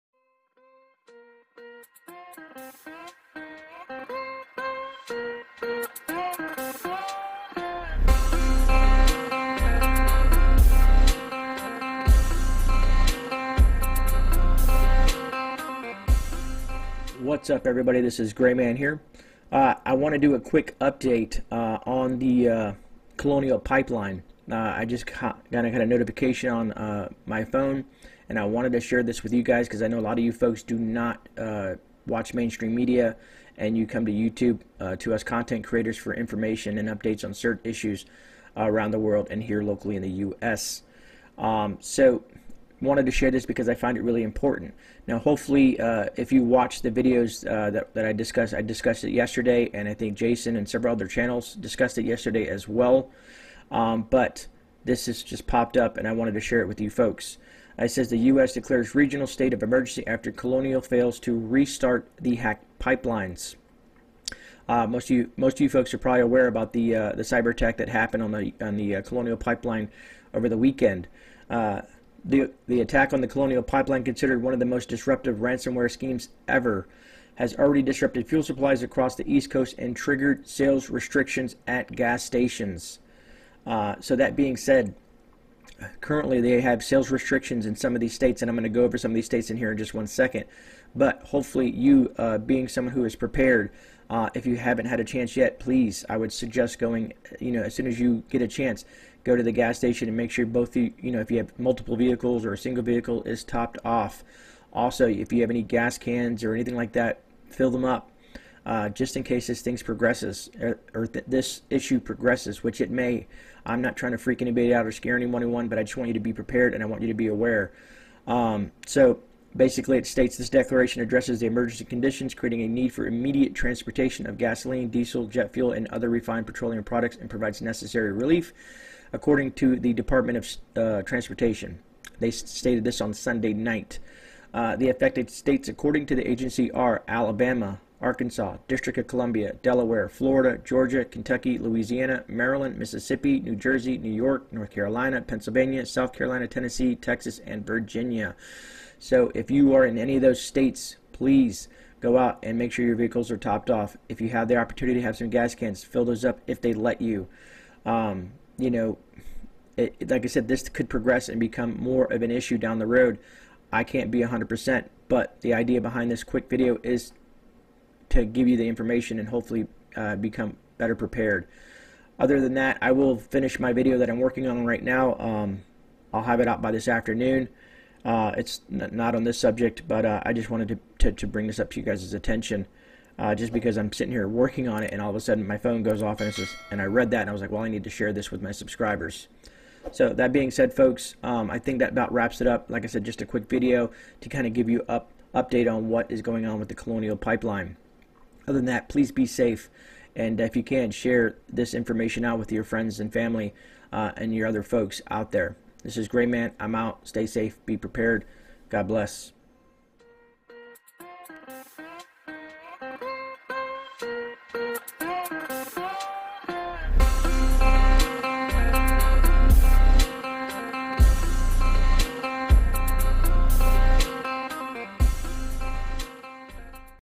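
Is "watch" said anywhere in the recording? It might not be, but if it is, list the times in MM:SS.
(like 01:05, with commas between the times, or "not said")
00:32, 00:46.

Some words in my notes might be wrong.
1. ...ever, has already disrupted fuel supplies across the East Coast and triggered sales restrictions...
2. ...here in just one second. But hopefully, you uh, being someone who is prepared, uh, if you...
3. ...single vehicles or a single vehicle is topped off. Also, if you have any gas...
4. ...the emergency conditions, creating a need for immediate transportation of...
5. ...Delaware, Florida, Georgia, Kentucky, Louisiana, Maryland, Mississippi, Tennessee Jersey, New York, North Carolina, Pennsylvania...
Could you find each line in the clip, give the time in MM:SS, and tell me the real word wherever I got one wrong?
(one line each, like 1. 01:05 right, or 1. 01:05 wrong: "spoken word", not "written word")
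1. 01:16 right
2. 01:29 right
3. 01:41 wrong: "multiple", not "single"
4. 02:01 right
5. 02:19 wrong: "New", not "Tennessee".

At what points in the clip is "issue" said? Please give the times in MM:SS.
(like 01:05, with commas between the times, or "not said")
00:37, 01:51, 02:42.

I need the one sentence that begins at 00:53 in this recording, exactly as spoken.
Um, but this has just popped up, and I wanted to share it with you folks.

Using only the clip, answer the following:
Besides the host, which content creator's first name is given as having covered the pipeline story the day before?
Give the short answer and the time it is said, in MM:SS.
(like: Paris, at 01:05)
Jason, at 00:50.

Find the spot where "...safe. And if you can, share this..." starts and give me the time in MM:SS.
03:19.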